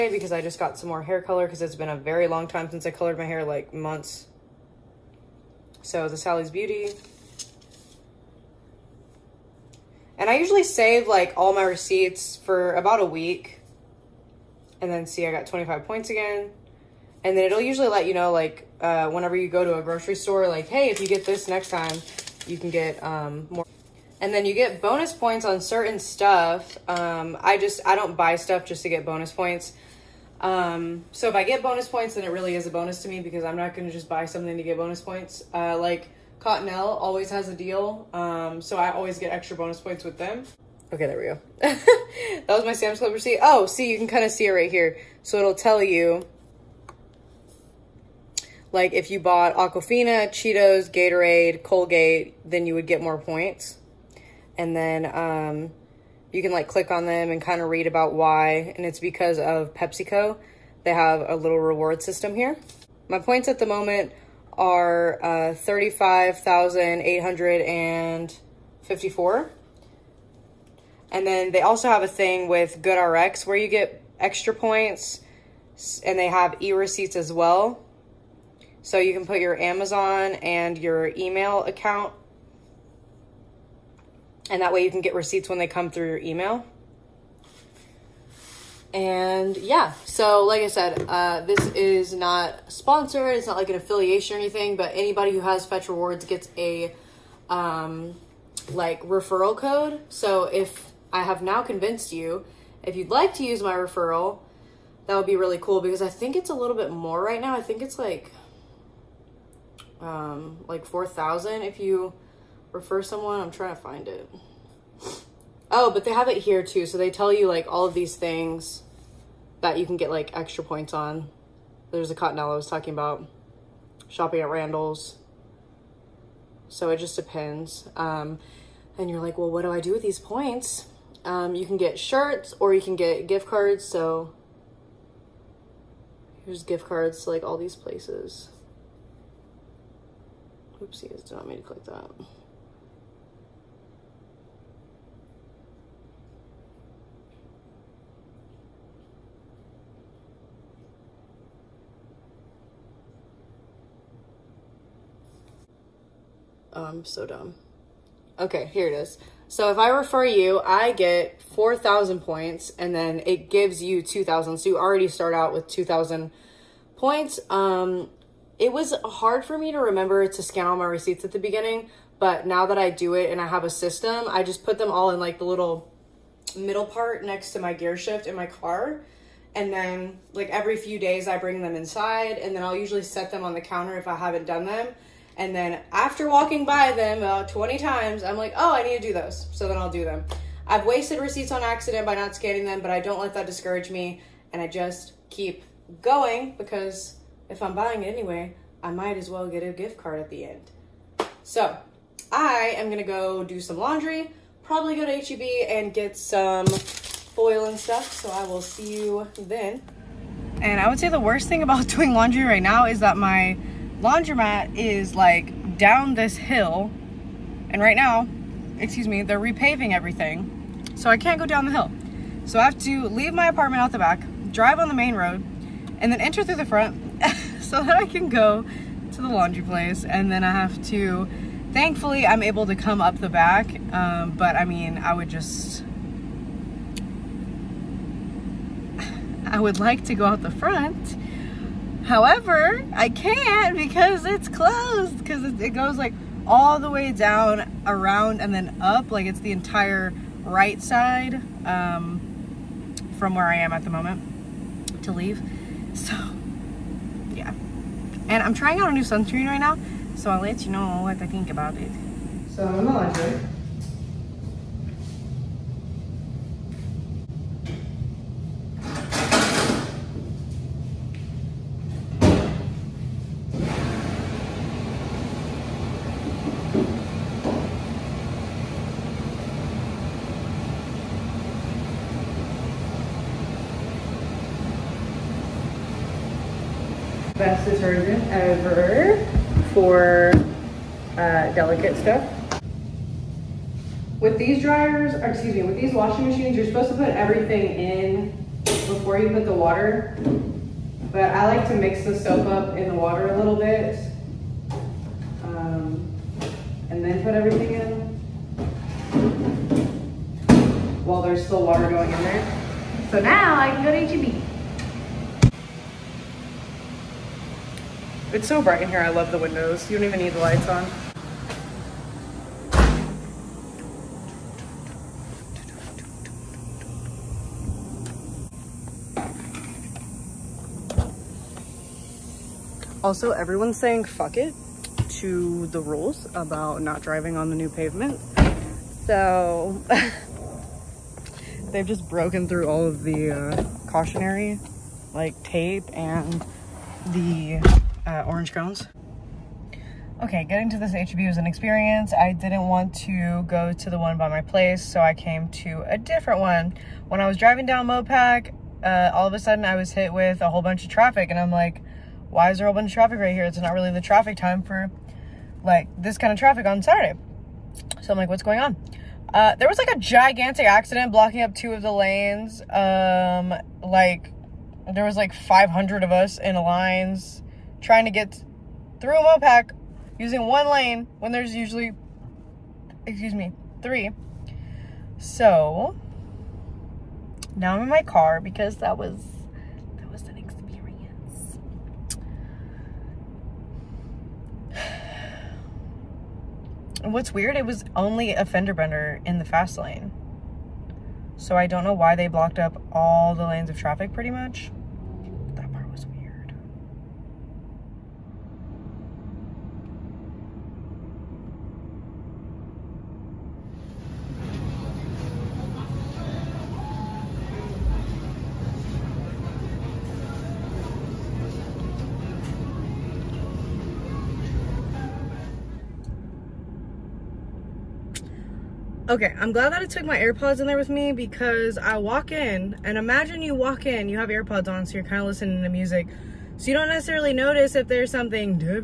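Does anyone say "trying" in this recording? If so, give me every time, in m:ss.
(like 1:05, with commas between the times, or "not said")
1:53, 4:18, 6:17.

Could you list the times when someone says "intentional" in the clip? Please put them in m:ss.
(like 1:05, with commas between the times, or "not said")
not said.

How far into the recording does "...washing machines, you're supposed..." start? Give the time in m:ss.
4:55.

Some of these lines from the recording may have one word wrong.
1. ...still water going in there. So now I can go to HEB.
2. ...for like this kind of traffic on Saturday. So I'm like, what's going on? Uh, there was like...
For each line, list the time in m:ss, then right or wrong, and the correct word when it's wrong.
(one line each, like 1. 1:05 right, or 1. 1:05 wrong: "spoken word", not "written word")
1. 5:11 right
2. 6:04 right.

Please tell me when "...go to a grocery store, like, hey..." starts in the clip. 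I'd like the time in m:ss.
0:19.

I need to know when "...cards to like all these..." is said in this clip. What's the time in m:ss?
2:16.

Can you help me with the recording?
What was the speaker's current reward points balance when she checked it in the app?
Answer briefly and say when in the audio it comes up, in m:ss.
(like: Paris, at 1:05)
35,854, at 1:05.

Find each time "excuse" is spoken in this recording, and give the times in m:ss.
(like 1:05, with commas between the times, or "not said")
3:38, 4:55, 6:23.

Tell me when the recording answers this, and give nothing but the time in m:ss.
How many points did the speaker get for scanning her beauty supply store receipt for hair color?
0:15.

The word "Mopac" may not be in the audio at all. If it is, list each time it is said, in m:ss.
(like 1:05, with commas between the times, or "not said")
5:57, 6:19.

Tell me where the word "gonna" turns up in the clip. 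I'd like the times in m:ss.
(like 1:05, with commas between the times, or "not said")
3:22.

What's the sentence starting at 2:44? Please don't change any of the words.
So you already start out with 2,000 points.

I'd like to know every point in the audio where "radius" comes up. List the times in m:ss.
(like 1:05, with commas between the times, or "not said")
not said.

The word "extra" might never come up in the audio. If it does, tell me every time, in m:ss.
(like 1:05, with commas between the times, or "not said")
0:39, 1:14, 2:00.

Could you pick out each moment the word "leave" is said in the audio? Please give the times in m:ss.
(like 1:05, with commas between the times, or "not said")
3:43, 4:15.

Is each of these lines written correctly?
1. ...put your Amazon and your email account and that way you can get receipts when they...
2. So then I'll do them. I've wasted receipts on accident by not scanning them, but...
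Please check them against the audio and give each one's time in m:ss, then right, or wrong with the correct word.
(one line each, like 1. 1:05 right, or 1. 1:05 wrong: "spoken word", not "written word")
1. 1:19 right
2. 3:09 right.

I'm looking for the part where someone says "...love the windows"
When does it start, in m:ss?
5:19.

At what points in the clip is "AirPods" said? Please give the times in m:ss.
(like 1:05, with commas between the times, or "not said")
7:10, 7:14.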